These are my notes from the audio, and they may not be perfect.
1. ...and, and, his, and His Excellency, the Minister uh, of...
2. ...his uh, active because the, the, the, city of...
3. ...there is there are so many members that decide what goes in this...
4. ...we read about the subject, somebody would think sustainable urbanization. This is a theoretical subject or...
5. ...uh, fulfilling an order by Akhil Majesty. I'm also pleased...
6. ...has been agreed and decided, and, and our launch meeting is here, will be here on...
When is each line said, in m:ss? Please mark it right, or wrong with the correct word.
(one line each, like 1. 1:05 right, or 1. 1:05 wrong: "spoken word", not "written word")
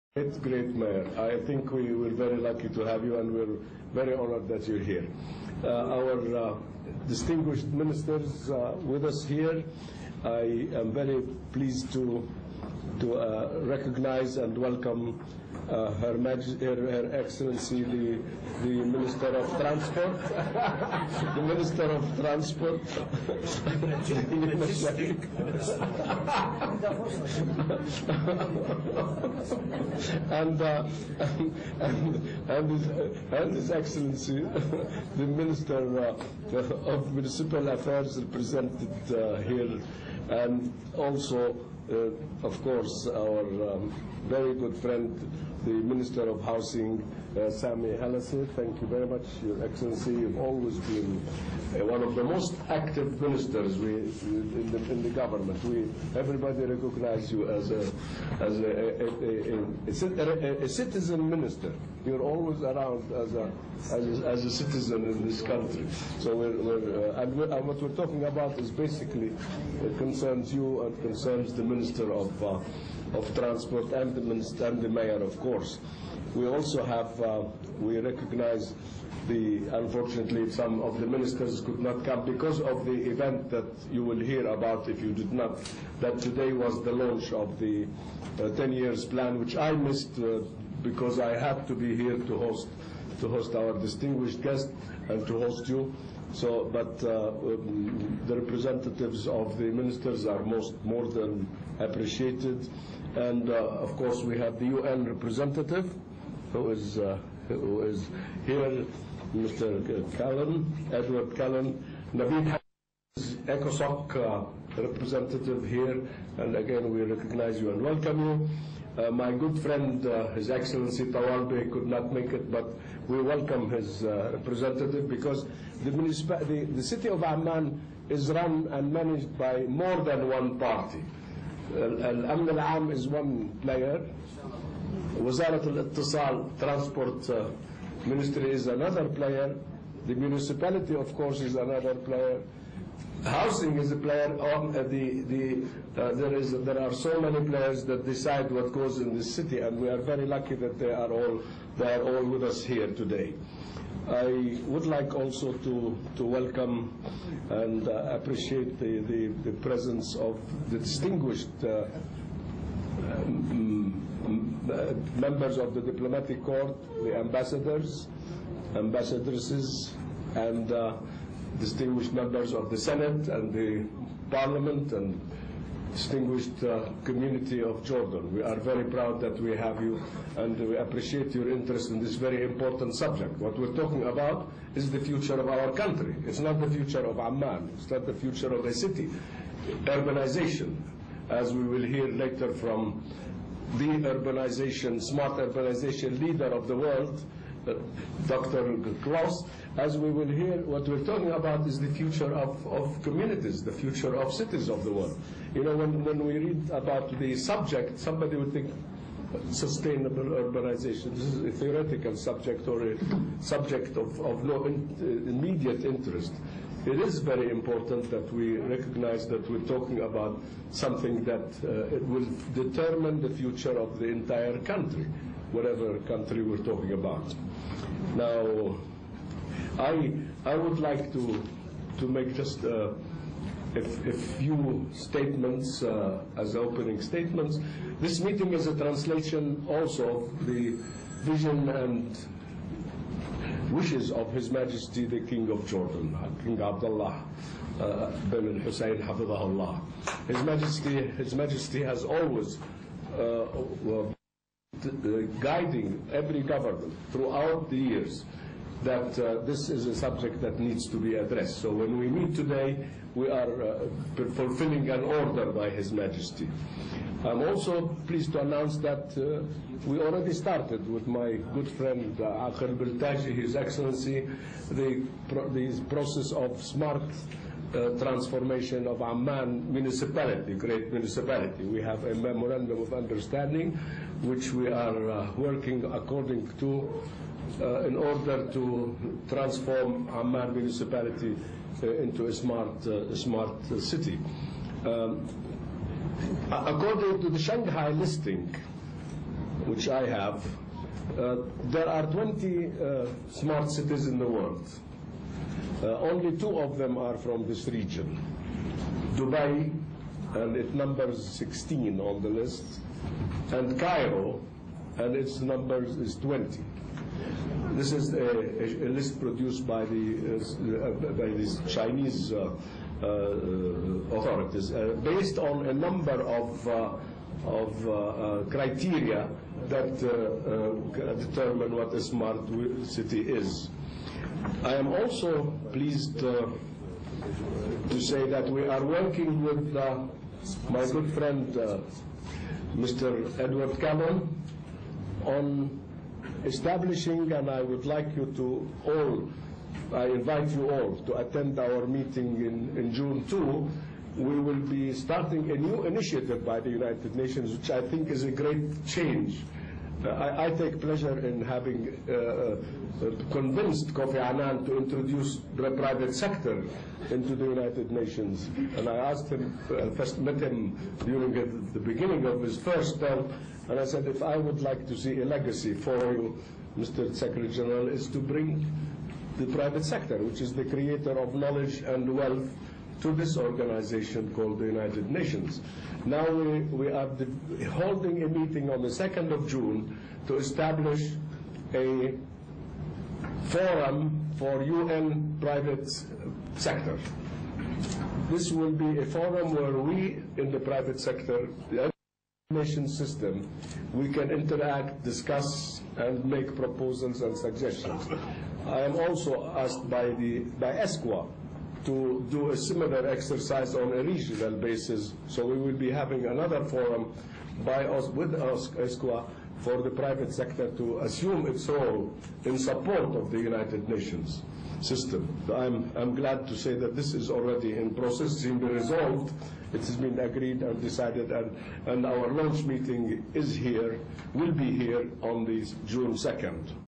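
1. 0:31 right
2. 2:03 wrong: "representative", not "active"
3. 2:26 wrong: "players", not "members"
4. 3:26 right
5. 4:23 wrong: "His", not "Akhil"
6. 7:09 right.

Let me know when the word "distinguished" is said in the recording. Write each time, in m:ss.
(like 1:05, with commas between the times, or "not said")
0:07, 1:33, 2:40, 2:51, 2:55.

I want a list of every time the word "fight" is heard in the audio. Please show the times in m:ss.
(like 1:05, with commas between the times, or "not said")
not said.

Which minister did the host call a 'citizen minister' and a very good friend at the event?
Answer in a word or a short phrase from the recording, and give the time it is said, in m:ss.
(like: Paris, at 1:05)
Sami Halase, at 0:47.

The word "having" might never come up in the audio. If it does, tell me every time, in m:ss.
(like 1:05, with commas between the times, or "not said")
6:01, 6:55.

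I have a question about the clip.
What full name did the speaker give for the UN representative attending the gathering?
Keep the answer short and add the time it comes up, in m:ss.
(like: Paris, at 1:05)
Edward Kallon, at 1:50.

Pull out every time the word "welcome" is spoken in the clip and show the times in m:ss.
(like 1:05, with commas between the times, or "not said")
0:14, 1:57, 2:03, 2:36.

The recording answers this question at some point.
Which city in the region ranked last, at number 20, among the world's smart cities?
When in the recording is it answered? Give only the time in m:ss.
5:13.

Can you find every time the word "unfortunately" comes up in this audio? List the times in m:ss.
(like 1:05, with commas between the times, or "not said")
1:19.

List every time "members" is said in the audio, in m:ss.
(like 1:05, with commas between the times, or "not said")
2:45, 2:52.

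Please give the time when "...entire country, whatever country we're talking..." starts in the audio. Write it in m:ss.
3:44.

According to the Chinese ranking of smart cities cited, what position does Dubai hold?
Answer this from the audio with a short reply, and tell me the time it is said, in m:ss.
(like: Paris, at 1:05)
16, at 5:11.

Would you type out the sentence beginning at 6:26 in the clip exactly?
Now we, we are holding a meeting on the 2nd of June to establish a forum for UN private sector.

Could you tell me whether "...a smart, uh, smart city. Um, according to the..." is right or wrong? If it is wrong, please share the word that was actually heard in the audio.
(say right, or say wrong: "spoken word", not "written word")
right.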